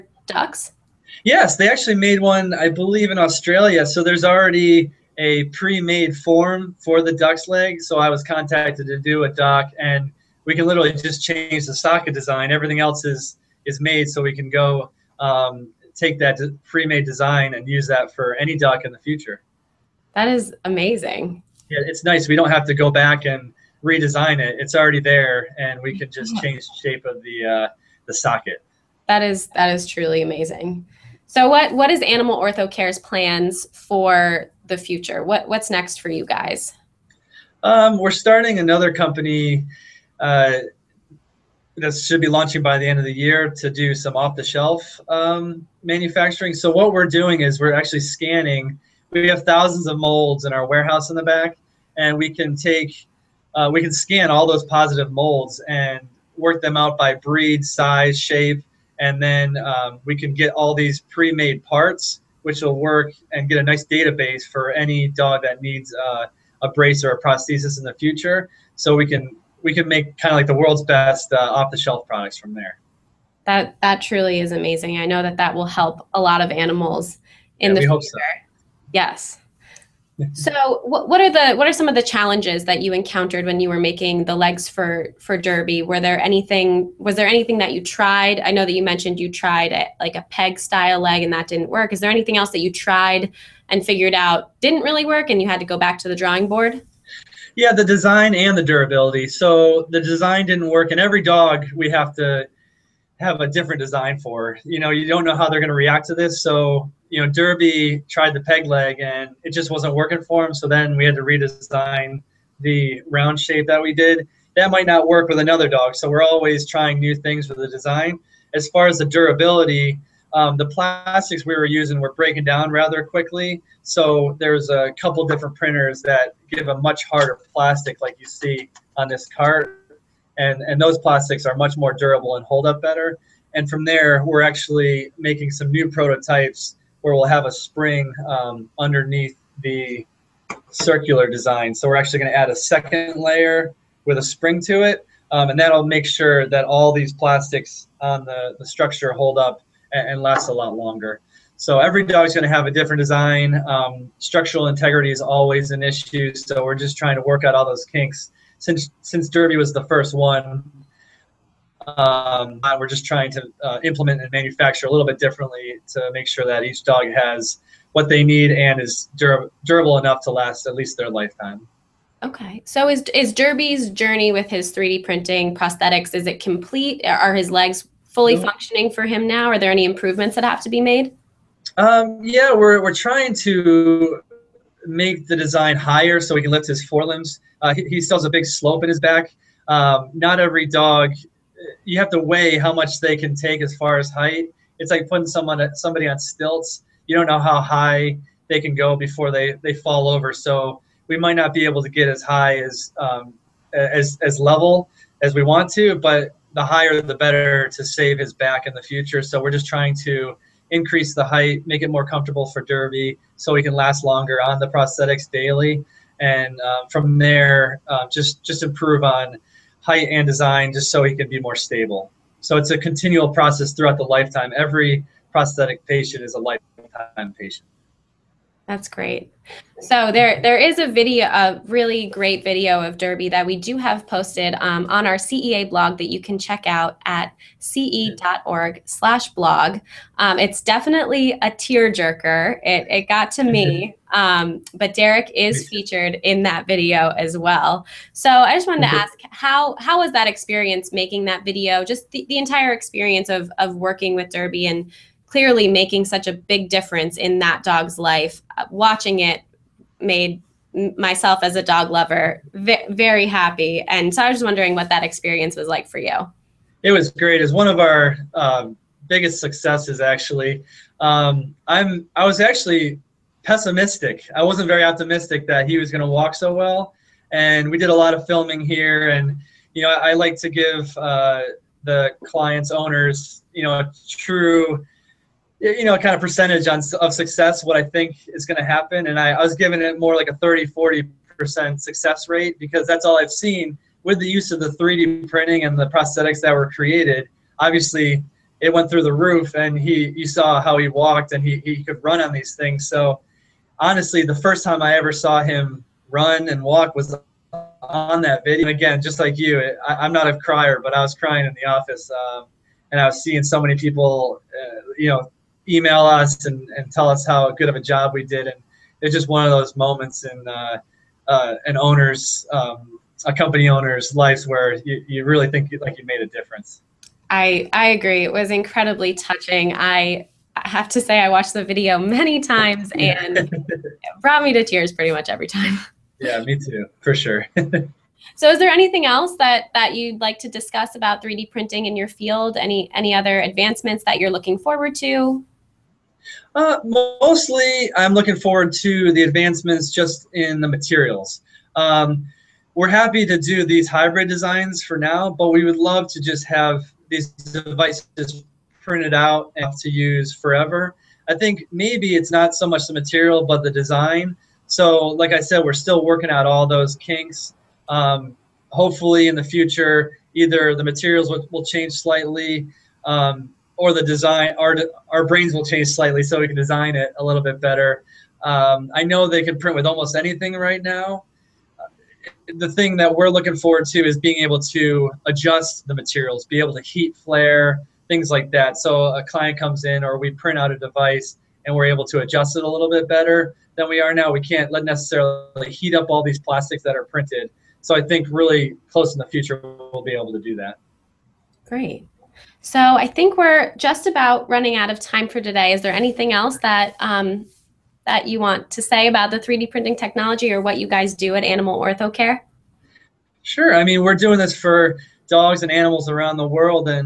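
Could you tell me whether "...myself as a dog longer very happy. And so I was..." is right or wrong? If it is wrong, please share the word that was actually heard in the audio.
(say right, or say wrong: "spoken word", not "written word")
wrong: "lover", not "longer".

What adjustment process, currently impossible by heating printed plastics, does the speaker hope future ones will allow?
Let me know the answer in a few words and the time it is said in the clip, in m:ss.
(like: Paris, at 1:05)
Heat flare, at 6:26.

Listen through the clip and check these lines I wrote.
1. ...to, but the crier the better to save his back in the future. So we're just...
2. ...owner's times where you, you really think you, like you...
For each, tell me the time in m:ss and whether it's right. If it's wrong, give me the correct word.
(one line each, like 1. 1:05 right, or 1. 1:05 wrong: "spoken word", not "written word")
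1. 3:25 wrong: "higher", not "crier"
2. 5:23 wrong: "lives", not "times".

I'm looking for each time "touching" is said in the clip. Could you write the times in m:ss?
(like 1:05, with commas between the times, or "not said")
5:29.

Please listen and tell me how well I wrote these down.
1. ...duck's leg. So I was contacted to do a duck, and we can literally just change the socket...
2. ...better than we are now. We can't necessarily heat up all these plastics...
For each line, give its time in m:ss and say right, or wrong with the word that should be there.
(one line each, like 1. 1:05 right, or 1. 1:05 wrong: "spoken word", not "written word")
1. 0:07 right
2. 6:33 right.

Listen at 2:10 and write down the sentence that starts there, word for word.
And, and those plastics are much more durable and hold up better.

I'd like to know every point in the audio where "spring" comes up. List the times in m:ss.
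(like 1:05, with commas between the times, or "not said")
2:17, 2:24.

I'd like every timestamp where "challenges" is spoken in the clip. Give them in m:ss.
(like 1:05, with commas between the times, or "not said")
1:22.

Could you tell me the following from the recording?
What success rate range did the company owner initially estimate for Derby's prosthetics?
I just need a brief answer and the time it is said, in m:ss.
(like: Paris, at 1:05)
30-40%, at 4:50.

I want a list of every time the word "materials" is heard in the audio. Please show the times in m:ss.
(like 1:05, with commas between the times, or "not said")
5:50, 6:02, 6:10, 6:25.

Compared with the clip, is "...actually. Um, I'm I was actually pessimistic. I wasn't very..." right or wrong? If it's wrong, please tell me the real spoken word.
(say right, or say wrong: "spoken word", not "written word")
right.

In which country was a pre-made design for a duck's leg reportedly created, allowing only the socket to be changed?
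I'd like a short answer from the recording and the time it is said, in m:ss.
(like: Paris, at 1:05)
Australia, at 0:03.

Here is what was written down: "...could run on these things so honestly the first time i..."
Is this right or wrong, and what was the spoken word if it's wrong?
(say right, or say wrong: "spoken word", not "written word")
right.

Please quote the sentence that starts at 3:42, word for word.
So it's a continual process throughout the lifetime.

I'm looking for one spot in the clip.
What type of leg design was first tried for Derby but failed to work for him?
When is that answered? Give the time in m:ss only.
1:48.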